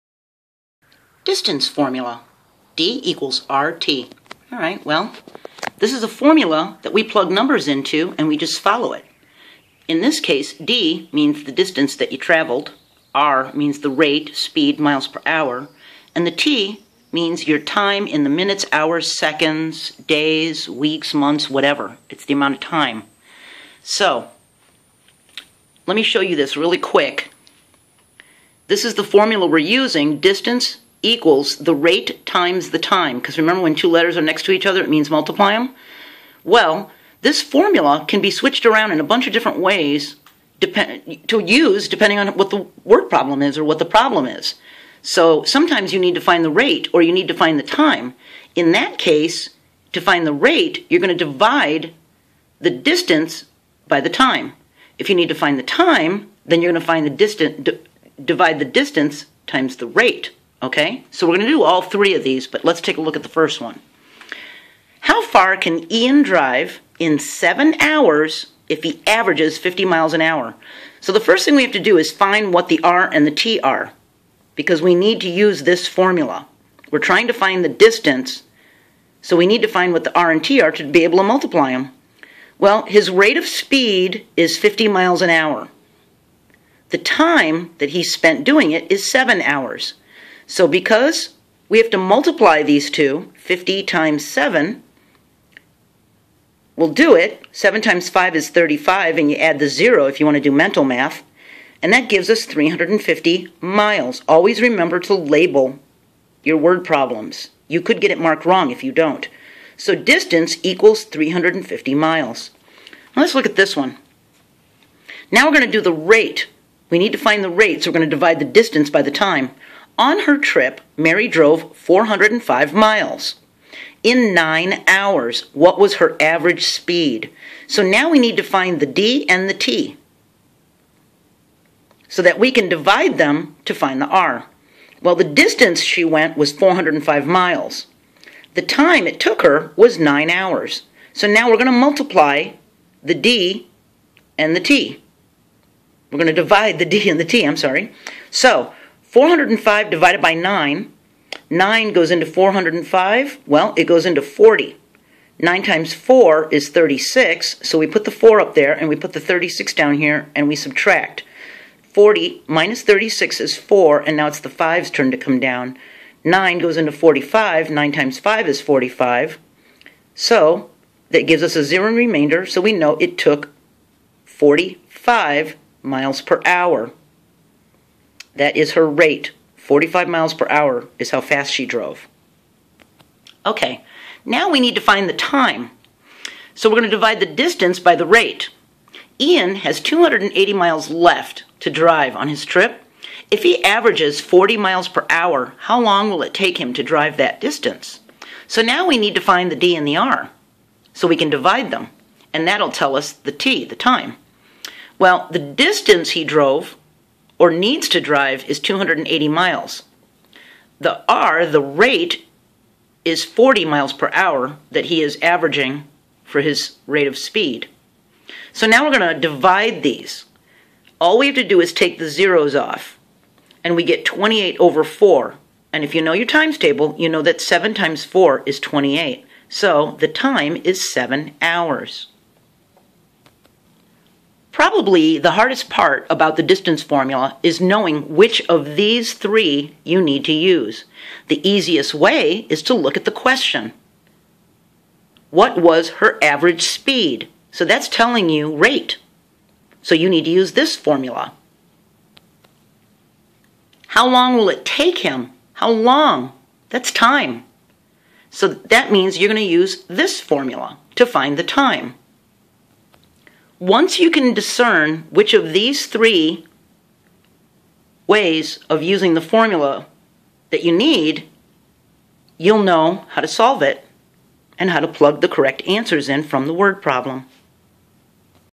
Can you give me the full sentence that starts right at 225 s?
And if you know your times table, you know that 7 times 4 is 28.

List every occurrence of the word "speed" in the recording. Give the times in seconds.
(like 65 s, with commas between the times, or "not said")
14 s, 83 s, 126 s, 217 s, 246 s.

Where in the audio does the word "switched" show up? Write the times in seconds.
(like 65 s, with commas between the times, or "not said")
38 s.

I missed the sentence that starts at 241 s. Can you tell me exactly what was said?
The easiest way is to look at the question.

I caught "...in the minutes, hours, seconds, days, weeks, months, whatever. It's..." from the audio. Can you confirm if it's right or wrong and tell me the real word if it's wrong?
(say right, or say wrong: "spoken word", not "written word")
right.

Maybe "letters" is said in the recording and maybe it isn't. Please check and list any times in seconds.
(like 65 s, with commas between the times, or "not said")
33 s.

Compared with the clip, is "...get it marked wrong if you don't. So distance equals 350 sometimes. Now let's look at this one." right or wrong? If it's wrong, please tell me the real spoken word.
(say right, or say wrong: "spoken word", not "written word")
wrong: "miles", not "sometimes".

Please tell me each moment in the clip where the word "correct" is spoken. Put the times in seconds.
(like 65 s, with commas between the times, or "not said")
275 s.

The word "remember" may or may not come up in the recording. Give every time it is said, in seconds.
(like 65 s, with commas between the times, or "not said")
33 s, 104 s.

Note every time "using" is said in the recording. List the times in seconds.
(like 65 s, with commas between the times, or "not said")
29 s, 268 s.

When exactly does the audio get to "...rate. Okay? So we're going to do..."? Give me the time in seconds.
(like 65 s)
59 s.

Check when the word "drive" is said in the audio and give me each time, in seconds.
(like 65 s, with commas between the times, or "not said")
66 s, 191 s, 196 s, 207 s.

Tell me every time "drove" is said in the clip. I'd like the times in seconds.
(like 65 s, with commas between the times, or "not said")
121 s, 181 s, 206 s.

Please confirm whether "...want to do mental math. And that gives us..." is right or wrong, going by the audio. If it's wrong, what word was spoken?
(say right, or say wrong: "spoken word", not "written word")
right.